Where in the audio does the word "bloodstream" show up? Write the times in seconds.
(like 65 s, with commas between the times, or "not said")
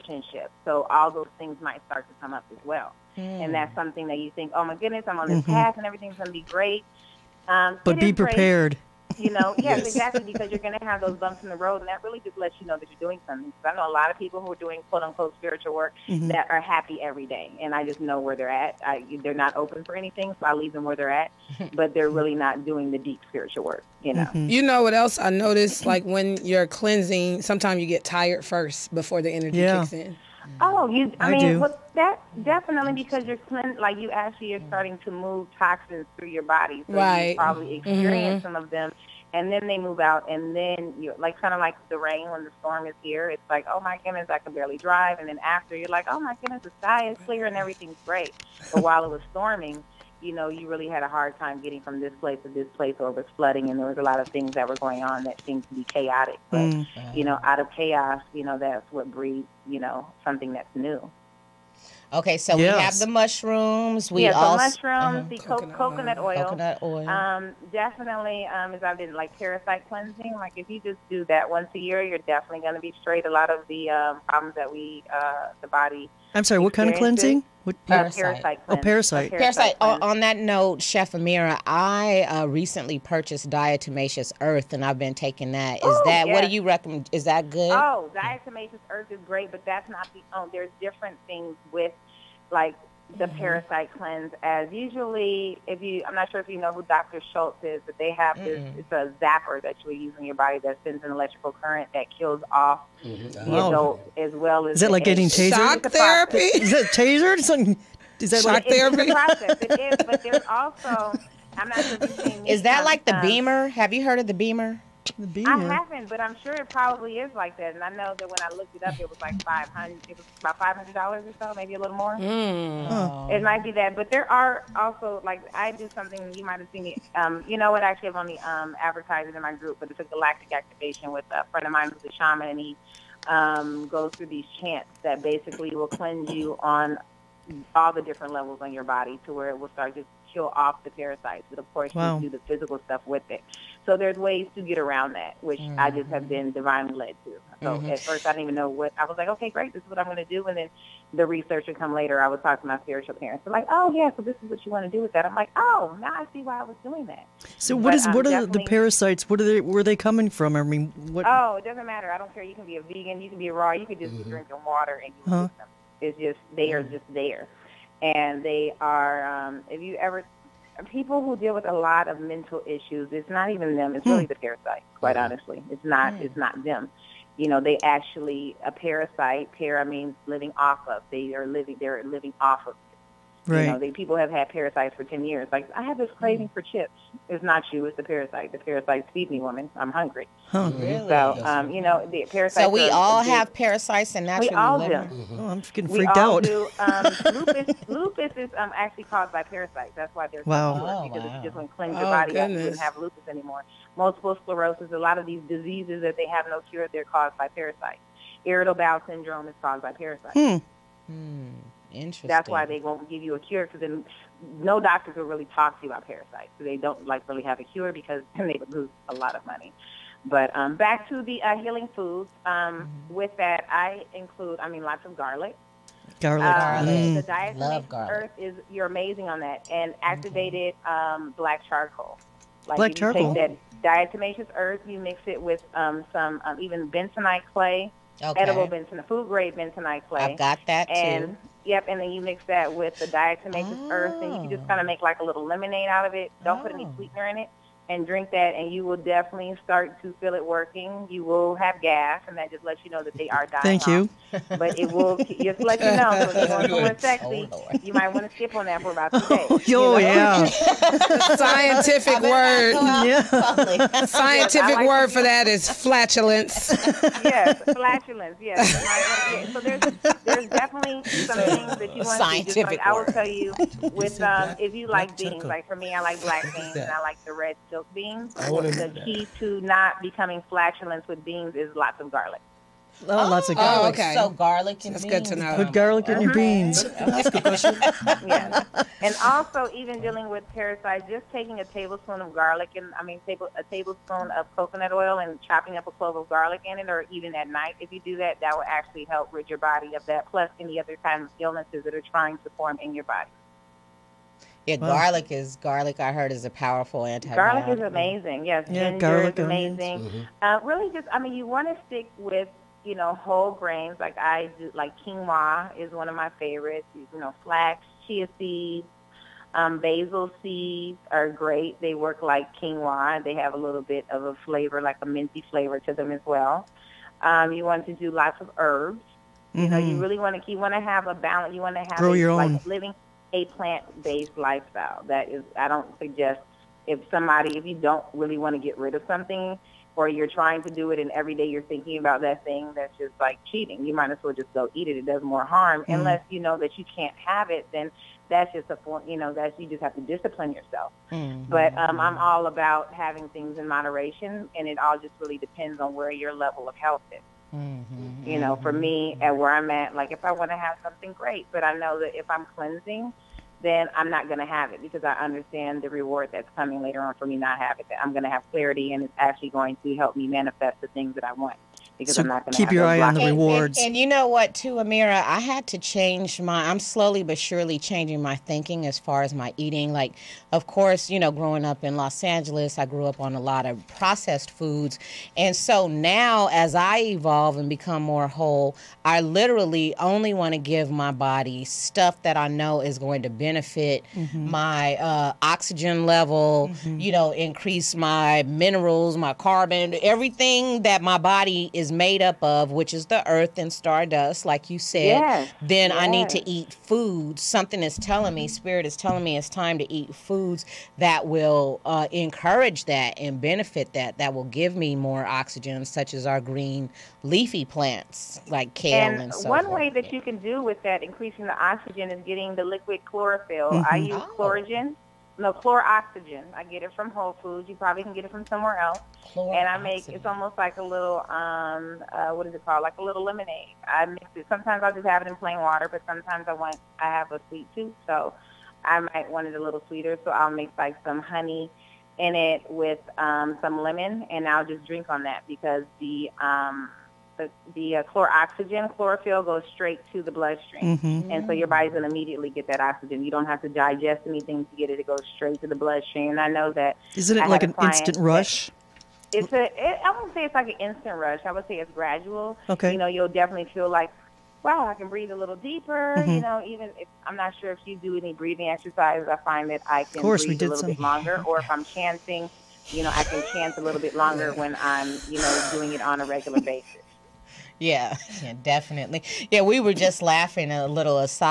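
450 s, 455 s.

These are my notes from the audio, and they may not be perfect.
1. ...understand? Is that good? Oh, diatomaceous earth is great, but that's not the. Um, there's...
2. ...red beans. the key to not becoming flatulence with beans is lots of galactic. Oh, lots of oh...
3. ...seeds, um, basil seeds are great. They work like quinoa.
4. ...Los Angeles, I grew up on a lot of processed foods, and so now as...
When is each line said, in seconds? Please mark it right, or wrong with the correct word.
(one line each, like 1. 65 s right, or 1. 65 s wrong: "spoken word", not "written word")
1. 86 s wrong: "recommend", not "understand"
2. 277 s wrong: "garlic", not "galactic"
3. 318 s right
4. 381 s right.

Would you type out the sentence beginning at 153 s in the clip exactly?
They're like, oh yeah, so this is what you want to do with that.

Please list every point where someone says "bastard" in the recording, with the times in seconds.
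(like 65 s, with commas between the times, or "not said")
not said.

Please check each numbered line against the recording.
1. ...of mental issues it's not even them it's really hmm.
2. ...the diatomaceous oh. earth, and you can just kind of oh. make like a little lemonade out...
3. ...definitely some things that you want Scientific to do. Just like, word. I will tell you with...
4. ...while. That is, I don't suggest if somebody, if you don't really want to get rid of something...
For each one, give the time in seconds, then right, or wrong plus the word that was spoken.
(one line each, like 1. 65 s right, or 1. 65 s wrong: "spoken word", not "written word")
1. 172 s right
2. 242 s right
3. 270 s right
4. 334 s wrong: "lifestyle", not "while".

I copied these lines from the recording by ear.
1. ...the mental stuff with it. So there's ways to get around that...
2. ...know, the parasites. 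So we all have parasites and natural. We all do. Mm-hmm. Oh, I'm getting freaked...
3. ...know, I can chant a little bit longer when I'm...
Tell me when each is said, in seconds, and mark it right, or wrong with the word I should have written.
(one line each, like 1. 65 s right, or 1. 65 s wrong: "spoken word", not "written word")
1. 142 s wrong: "physical", not "mental"
2. 191 s right
3. 473 s right.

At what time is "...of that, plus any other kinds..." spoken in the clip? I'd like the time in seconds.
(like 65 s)
299 s.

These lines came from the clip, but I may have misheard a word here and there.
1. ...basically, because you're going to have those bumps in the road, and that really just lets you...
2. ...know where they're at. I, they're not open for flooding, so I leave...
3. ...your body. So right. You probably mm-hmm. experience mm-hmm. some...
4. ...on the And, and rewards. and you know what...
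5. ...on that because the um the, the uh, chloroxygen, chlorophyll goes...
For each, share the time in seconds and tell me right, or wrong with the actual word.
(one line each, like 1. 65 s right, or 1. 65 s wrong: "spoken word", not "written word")
1. 9 s wrong: "exactly", not "basically"
2. 17 s wrong: "anything", not "flooding"
3. 36 s right
4. 373 s right
5. 445 s right.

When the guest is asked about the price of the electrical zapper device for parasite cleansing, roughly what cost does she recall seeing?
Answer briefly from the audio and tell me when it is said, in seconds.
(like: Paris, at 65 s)
$500, at 120 s.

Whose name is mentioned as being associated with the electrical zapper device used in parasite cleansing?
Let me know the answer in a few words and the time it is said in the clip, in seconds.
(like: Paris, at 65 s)
Dr. Schultz, at 96 s.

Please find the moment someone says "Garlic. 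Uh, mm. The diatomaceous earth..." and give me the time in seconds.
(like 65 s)
226 s.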